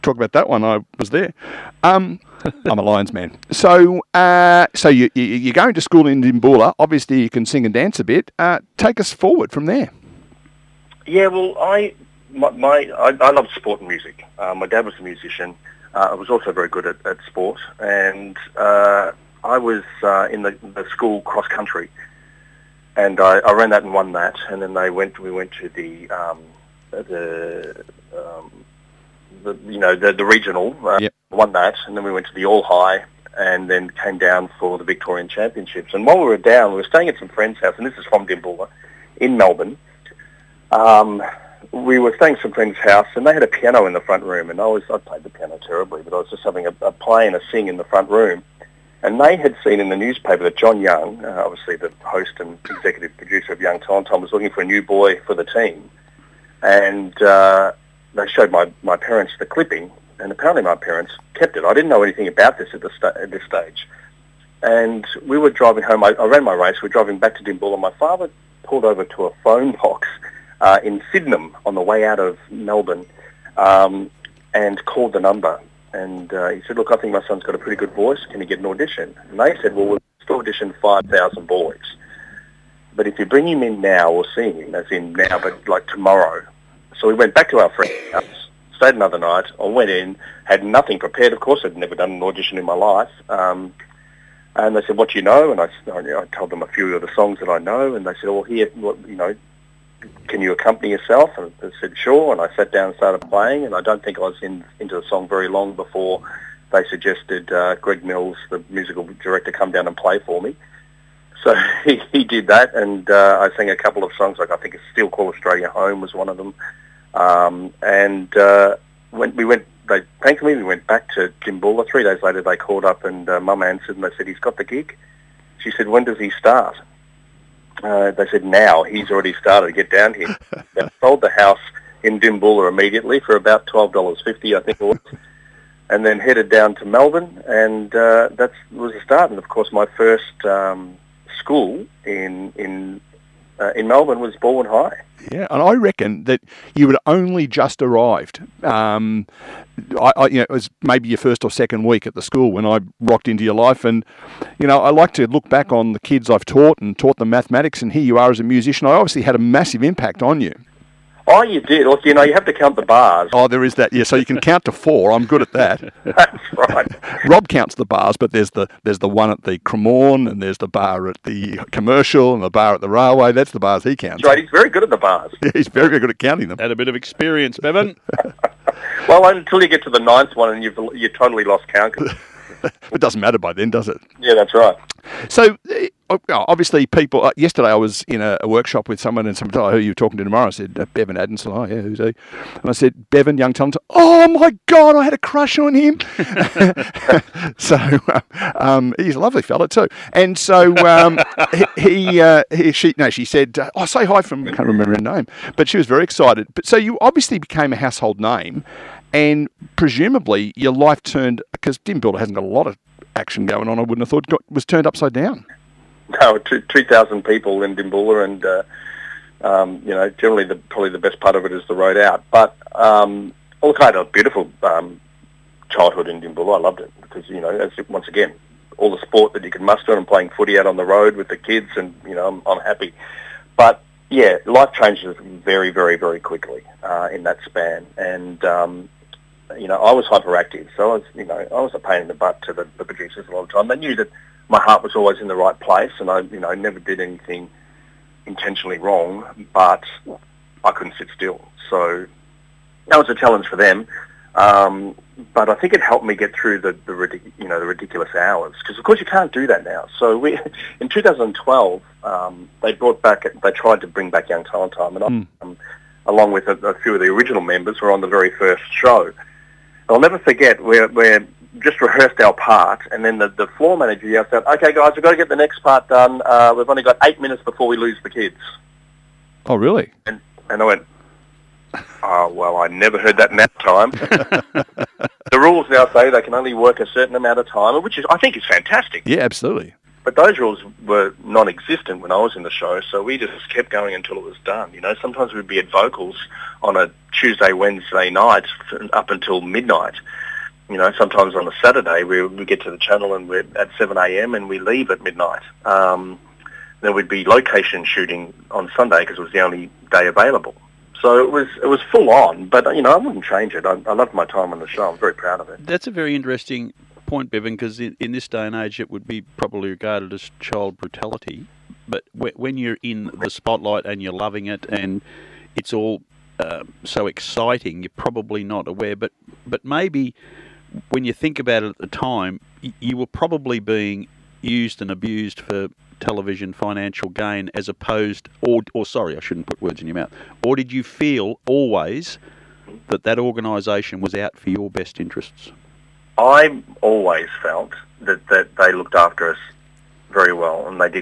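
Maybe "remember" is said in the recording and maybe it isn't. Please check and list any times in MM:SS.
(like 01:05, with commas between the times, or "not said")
03:24.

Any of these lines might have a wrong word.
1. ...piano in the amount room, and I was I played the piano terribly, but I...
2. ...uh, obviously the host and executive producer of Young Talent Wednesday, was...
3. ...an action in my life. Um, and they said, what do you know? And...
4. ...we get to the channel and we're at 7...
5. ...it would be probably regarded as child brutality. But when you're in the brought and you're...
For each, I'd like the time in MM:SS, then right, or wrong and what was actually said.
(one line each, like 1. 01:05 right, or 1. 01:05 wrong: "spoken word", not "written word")
1. 00:43 wrong: "front", not "amount"
2. 00:51 wrong: "Time", not "Wednesday"
3. 01:32 wrong: "audition", not "action"
4. 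05:02 right
5. 05:18 wrong: "spotlight", not "brought".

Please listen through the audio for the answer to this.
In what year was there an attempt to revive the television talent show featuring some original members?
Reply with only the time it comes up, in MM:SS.
04:20.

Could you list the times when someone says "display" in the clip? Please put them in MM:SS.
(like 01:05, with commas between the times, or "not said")
not said.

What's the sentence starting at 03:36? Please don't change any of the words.
No, 2,000 people in Dimboola and, uh, um, you know, generally the, probably the best part of it is the road out.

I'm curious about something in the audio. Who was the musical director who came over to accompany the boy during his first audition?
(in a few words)
Greg Mills.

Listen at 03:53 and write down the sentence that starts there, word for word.
But, yeah, life changes very, very, very quickly uh, in that span.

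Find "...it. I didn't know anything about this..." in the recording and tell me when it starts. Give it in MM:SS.
01:01.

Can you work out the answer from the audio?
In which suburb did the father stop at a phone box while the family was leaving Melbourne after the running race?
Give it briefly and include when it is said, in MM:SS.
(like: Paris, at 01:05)
Sydenham, at 01:11.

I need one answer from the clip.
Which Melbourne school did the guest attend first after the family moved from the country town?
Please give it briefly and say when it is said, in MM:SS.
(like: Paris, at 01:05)
Balwyn High, at 02:24.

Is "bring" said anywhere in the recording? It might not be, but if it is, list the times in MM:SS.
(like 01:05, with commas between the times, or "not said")
01:23, 04:23.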